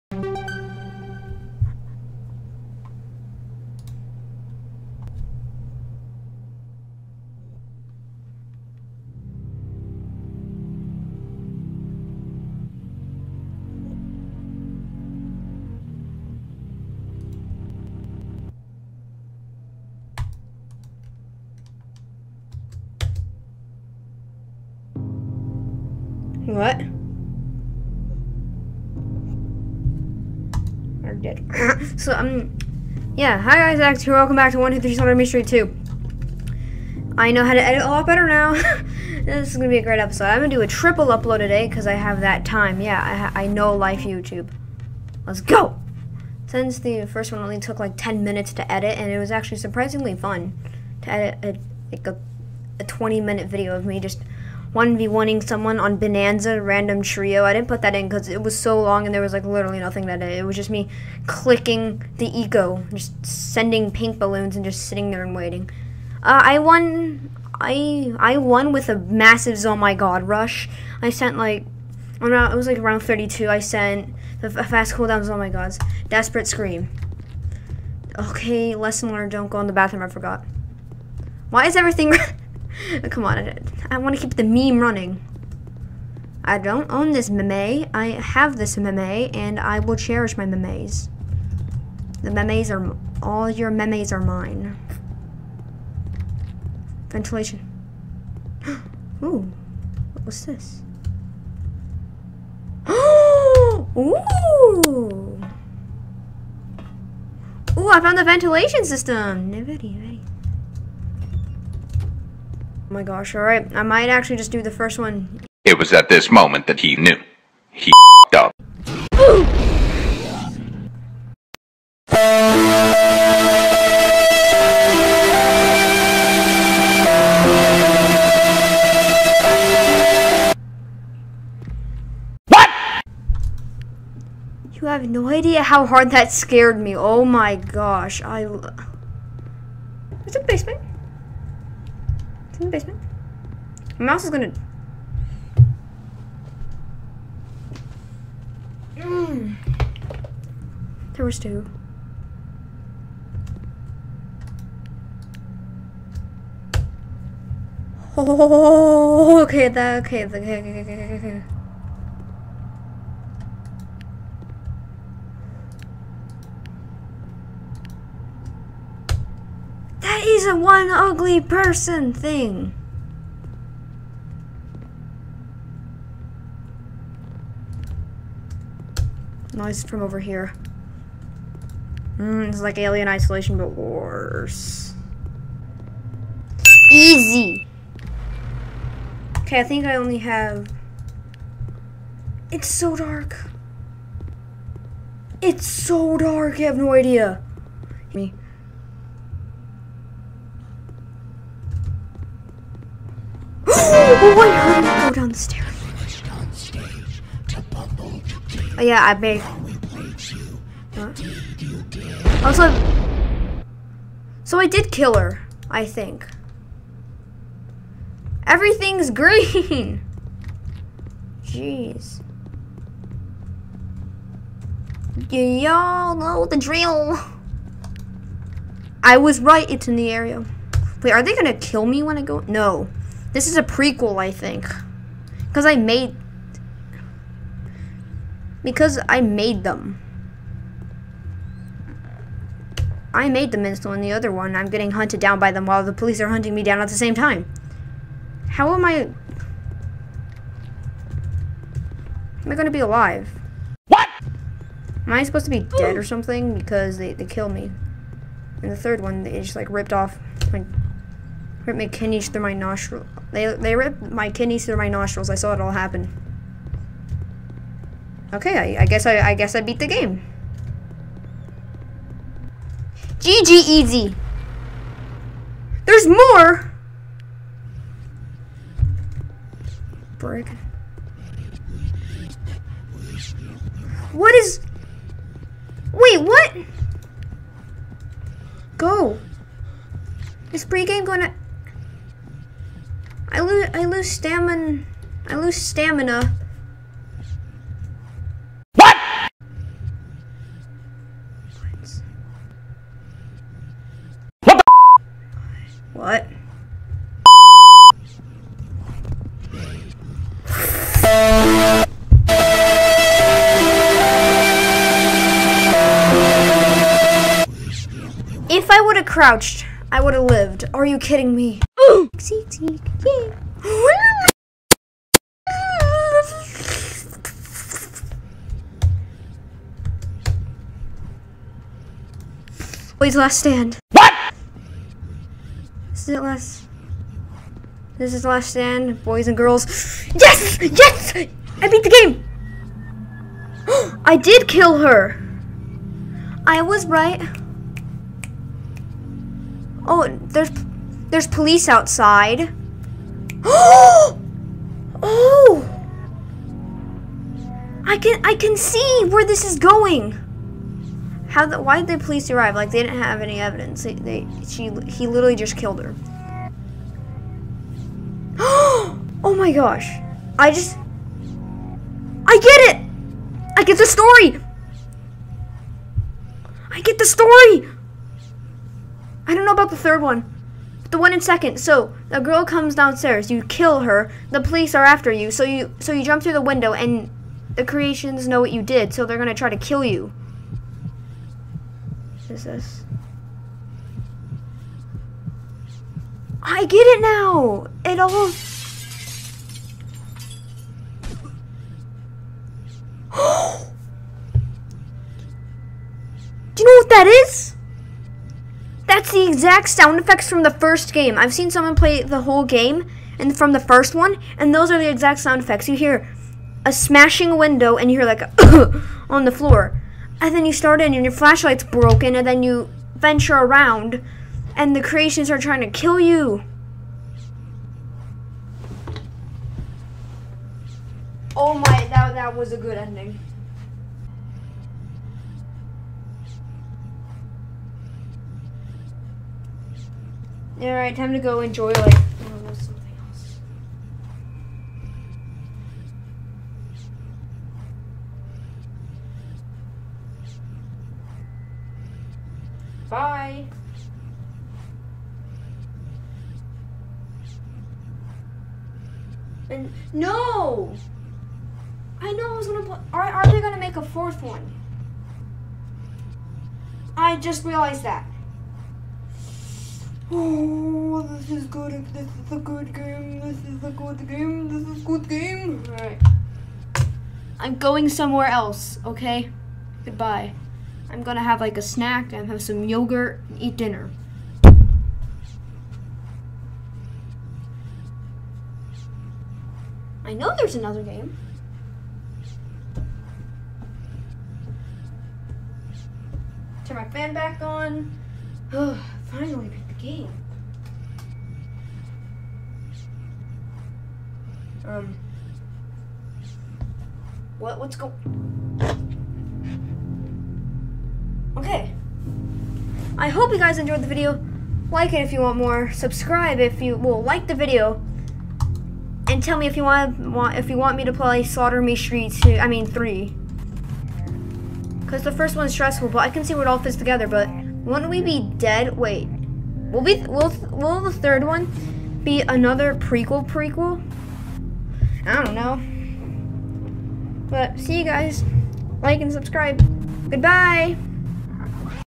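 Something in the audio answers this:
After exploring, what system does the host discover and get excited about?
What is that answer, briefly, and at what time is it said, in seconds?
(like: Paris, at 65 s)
Ventilation system, at 108 s.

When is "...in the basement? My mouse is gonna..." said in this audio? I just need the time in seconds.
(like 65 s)
142 s.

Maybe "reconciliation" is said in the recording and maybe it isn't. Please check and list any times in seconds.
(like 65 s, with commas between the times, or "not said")
not said.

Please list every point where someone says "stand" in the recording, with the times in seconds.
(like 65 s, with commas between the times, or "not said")
333 s, 338 s.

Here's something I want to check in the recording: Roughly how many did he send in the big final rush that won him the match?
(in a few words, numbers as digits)
32.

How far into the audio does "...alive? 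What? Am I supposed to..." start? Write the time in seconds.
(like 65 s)
252 s.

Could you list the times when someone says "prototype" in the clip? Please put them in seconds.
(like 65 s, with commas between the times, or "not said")
not said.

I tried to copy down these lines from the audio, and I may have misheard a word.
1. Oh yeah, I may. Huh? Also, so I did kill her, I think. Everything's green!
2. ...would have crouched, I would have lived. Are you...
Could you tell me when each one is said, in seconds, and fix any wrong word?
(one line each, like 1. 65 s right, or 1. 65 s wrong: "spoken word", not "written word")
1. 208 s right
2. 318 s right.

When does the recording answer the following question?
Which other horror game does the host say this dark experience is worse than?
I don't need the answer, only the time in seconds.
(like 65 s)
182 s.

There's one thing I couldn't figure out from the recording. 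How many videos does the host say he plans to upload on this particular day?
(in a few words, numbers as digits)
3.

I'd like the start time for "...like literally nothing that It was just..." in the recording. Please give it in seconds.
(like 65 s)
59 s.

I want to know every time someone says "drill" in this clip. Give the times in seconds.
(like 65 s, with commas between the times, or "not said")
226 s.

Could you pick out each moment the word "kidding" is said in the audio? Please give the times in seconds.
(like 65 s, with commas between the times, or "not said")
320 s.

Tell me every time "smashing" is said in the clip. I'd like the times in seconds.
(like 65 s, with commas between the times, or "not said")
416 s.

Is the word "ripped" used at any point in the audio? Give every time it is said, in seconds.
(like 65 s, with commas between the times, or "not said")
259 s, 263 s.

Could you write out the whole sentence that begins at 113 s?
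I might actually just do the first one.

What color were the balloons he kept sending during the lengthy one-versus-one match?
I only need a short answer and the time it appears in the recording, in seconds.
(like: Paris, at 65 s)
Pink, at 63 s.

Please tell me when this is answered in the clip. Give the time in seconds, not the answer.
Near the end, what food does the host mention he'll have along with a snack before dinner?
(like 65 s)
482 s.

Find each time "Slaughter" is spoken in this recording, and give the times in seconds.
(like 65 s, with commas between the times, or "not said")
34 s, 521 s.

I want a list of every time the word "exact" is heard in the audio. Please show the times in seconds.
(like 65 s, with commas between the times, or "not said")
409 s, 414 s.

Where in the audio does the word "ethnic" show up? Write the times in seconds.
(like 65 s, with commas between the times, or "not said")
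not said.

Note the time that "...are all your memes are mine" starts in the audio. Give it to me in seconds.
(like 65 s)
92 s.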